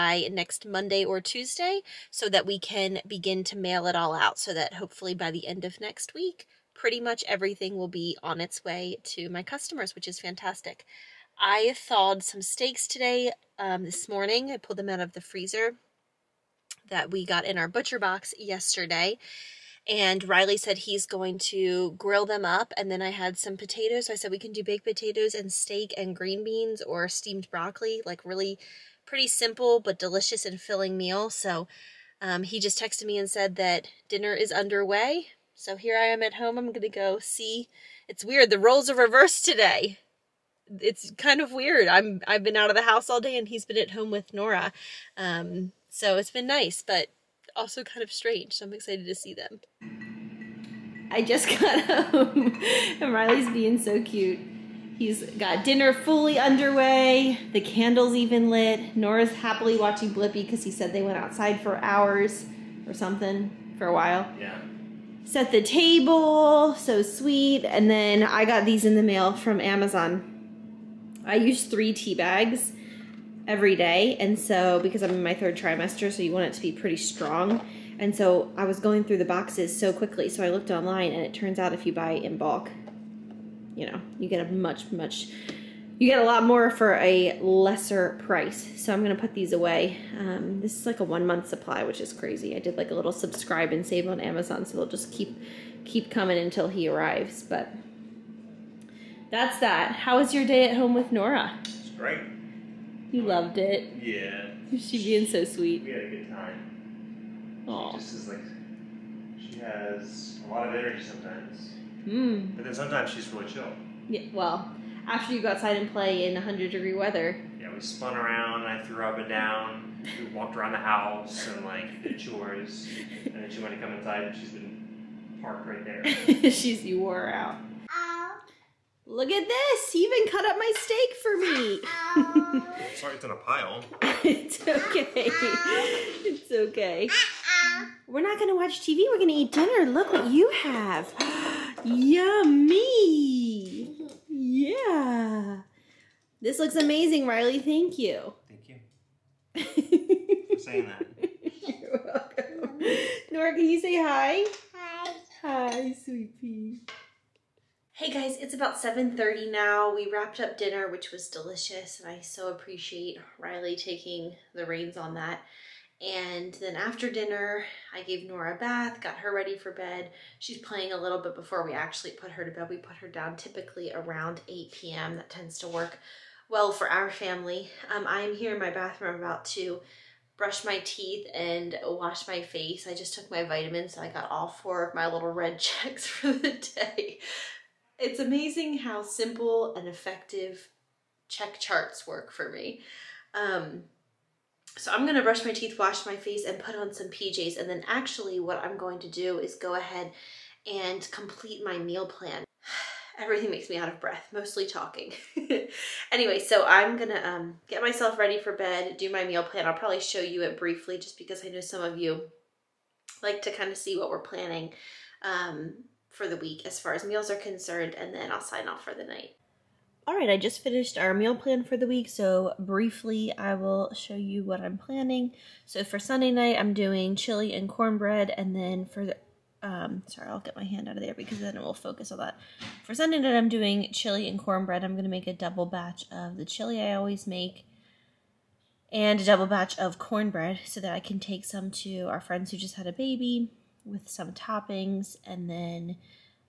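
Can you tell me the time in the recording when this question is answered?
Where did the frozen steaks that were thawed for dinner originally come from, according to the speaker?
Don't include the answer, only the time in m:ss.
0:17.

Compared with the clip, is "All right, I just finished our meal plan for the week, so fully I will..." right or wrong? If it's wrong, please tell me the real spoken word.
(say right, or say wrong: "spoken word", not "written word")
wrong: "briefly", not "fully".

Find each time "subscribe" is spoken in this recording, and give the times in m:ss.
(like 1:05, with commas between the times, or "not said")
1:33.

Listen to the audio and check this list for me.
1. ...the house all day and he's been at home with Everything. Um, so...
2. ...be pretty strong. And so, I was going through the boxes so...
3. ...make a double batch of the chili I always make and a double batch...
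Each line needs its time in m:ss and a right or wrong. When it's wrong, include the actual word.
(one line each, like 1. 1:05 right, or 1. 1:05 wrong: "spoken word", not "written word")
1. 0:42 wrong: "Nora", not "Everything"
2. 1:16 right
3. 3:55 right.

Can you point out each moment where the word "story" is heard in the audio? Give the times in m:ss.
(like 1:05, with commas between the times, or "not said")
not said.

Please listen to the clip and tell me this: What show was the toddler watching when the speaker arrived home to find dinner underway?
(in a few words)
Blippi.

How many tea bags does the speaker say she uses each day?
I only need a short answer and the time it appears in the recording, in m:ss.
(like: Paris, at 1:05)
3, at 1:11.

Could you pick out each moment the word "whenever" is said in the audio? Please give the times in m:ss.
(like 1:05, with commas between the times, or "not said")
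not said.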